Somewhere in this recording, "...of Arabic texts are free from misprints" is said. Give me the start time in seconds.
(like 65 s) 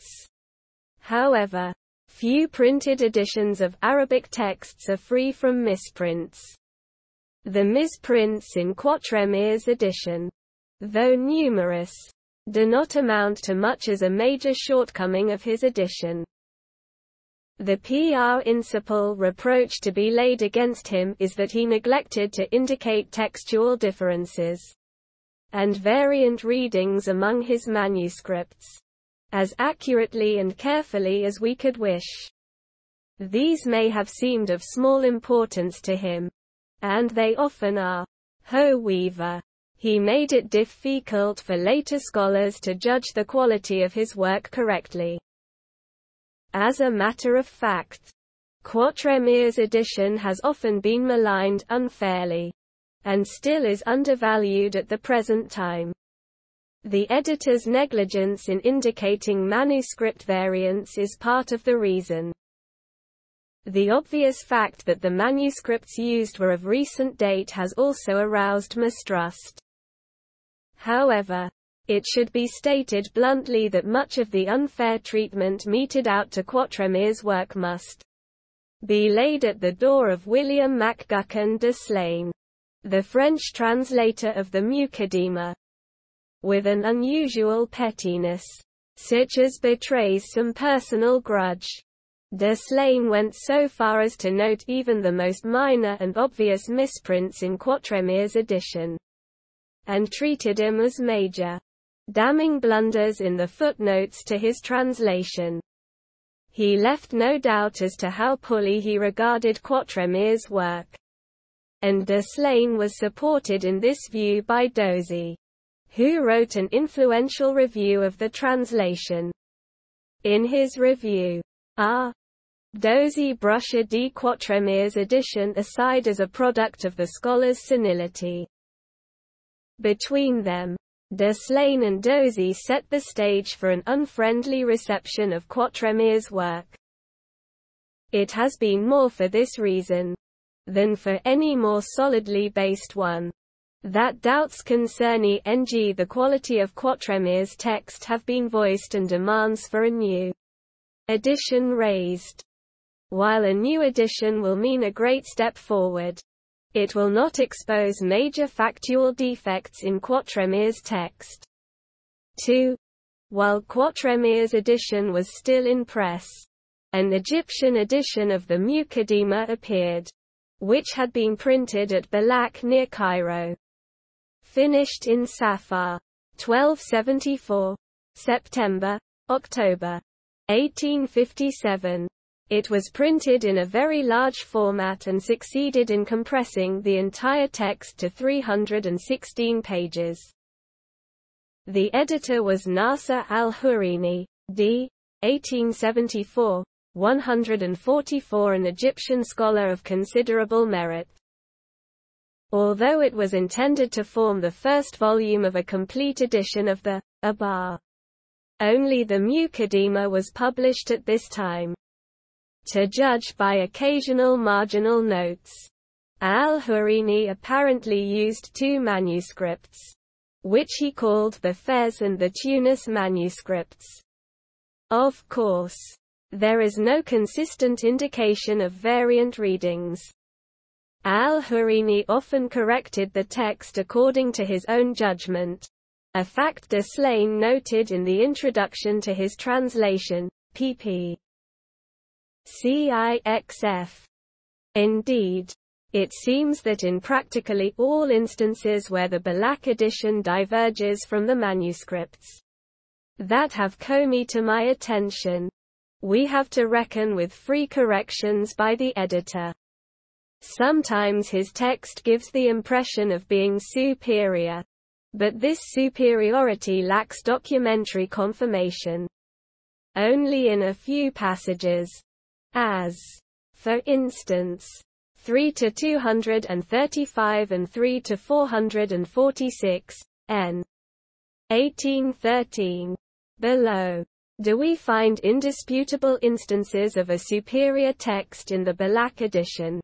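3 s.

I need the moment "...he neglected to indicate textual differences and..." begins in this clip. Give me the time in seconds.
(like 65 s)
21 s.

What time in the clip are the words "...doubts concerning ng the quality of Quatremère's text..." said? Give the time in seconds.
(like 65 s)
144 s.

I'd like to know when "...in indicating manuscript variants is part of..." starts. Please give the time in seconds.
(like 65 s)
58 s.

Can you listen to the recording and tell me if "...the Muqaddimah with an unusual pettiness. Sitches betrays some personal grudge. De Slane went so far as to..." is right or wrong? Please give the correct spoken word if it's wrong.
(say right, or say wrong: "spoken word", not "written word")
right.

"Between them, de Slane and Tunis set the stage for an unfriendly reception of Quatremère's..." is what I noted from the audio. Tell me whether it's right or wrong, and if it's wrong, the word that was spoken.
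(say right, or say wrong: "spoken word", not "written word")
wrong: "Dozy", not "Tunis".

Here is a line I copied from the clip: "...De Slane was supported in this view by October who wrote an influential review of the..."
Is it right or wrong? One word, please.
wrong.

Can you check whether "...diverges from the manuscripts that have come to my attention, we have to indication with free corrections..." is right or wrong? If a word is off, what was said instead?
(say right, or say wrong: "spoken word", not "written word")
wrong: "reckon", not "indication".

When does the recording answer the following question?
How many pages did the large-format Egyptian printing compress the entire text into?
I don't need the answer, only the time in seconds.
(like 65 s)
188 s.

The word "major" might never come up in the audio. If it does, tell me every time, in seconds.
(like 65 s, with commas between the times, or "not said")
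14 s, 100 s, 158 s.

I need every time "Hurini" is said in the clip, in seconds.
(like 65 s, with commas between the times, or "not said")
193 s, 216 s, 231 s.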